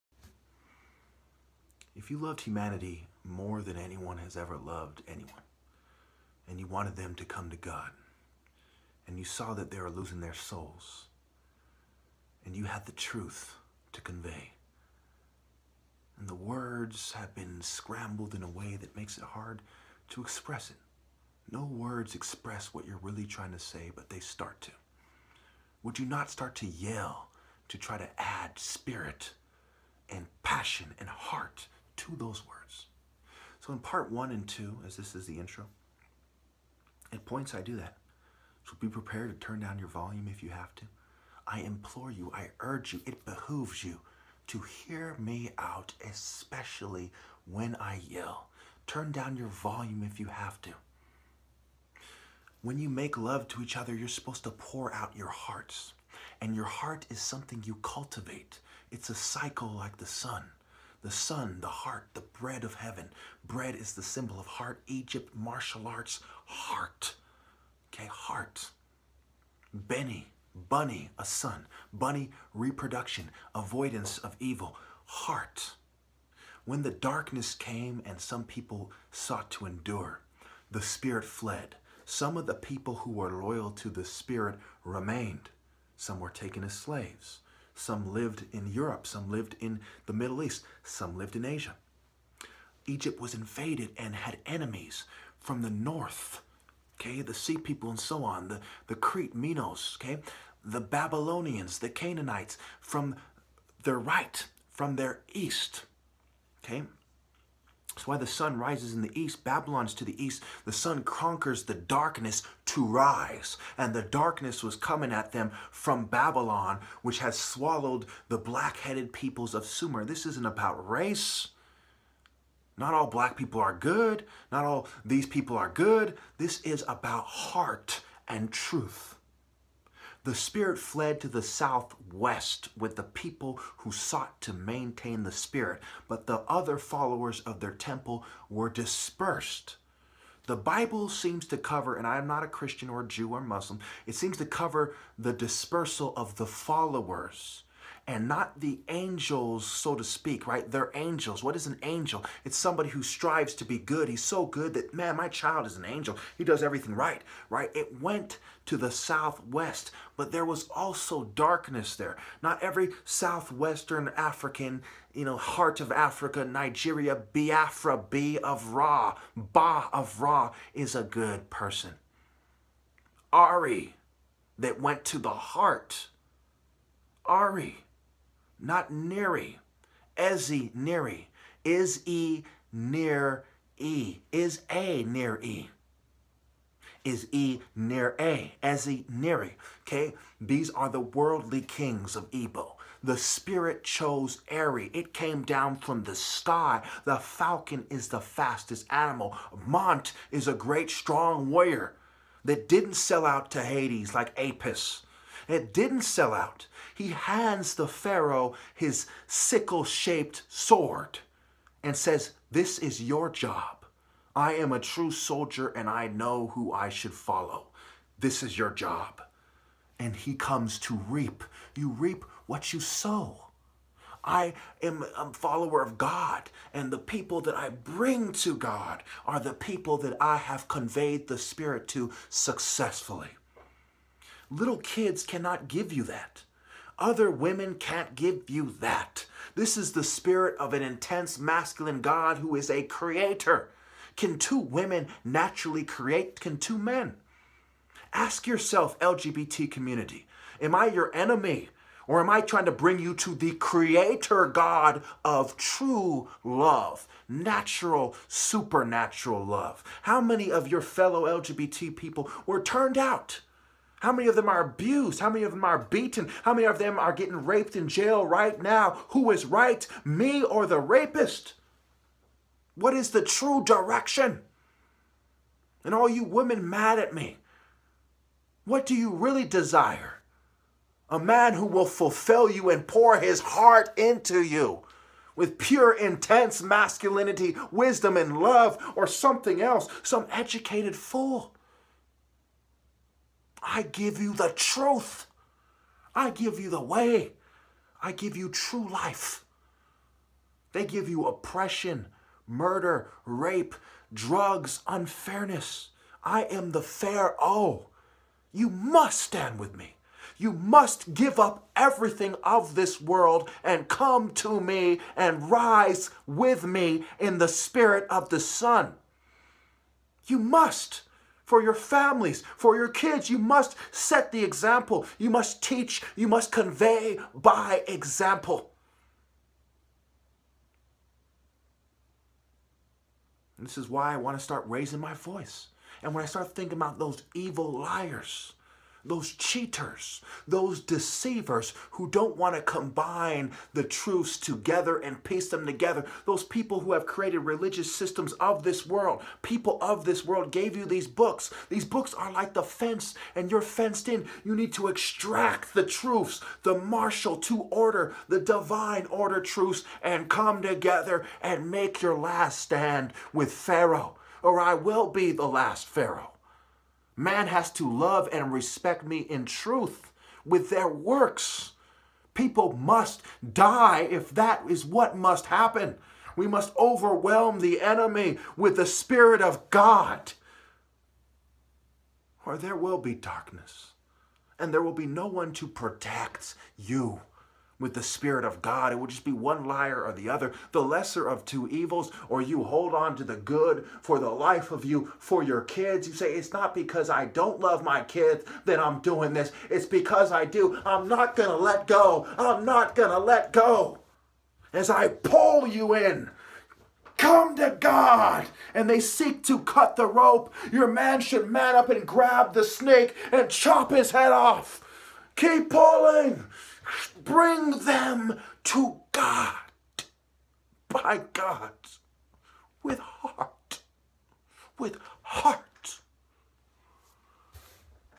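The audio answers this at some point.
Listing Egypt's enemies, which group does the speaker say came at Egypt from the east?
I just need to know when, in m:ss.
1:41.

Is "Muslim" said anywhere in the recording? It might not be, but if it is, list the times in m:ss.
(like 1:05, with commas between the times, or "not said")
2:23.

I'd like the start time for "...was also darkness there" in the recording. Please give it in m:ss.
2:40.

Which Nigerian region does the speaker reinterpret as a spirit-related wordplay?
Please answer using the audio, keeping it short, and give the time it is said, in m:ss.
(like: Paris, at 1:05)
Biafra, at 2:47.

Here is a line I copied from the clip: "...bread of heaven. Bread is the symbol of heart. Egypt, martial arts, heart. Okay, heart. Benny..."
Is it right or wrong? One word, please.
right.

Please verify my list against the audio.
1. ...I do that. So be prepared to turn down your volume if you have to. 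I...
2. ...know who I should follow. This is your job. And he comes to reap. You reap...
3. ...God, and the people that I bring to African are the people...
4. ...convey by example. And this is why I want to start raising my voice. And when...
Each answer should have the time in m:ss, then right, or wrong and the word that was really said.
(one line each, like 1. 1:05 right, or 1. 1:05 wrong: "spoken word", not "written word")
1. 0:37 right
2. 3:36 right
3. 3:45 wrong: "God", not "African"
4. 5:26 right.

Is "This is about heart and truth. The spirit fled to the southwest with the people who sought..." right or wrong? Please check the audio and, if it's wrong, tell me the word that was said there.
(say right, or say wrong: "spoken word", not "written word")
right.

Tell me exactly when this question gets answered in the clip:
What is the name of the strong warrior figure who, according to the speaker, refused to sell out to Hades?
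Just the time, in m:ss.
3:19.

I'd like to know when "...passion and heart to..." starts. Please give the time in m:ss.
0:30.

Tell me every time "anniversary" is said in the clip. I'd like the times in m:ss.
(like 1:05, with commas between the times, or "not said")
not said.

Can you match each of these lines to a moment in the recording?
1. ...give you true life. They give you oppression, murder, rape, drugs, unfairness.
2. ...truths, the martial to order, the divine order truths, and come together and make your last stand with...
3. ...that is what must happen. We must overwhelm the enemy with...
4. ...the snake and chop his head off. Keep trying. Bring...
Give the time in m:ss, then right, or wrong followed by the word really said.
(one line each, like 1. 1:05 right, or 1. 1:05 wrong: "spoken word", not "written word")
1. 4:58 right
2. 5:55 right
3. 6:14 right
4. 6:52 wrong: "pulling", not "trying".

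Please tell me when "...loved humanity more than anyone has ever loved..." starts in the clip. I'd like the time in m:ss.
0:02.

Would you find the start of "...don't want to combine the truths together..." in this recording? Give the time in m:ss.
5:42.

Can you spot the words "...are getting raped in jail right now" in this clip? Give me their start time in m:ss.
4:26.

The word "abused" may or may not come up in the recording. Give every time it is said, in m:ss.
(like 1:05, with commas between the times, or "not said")
4:24.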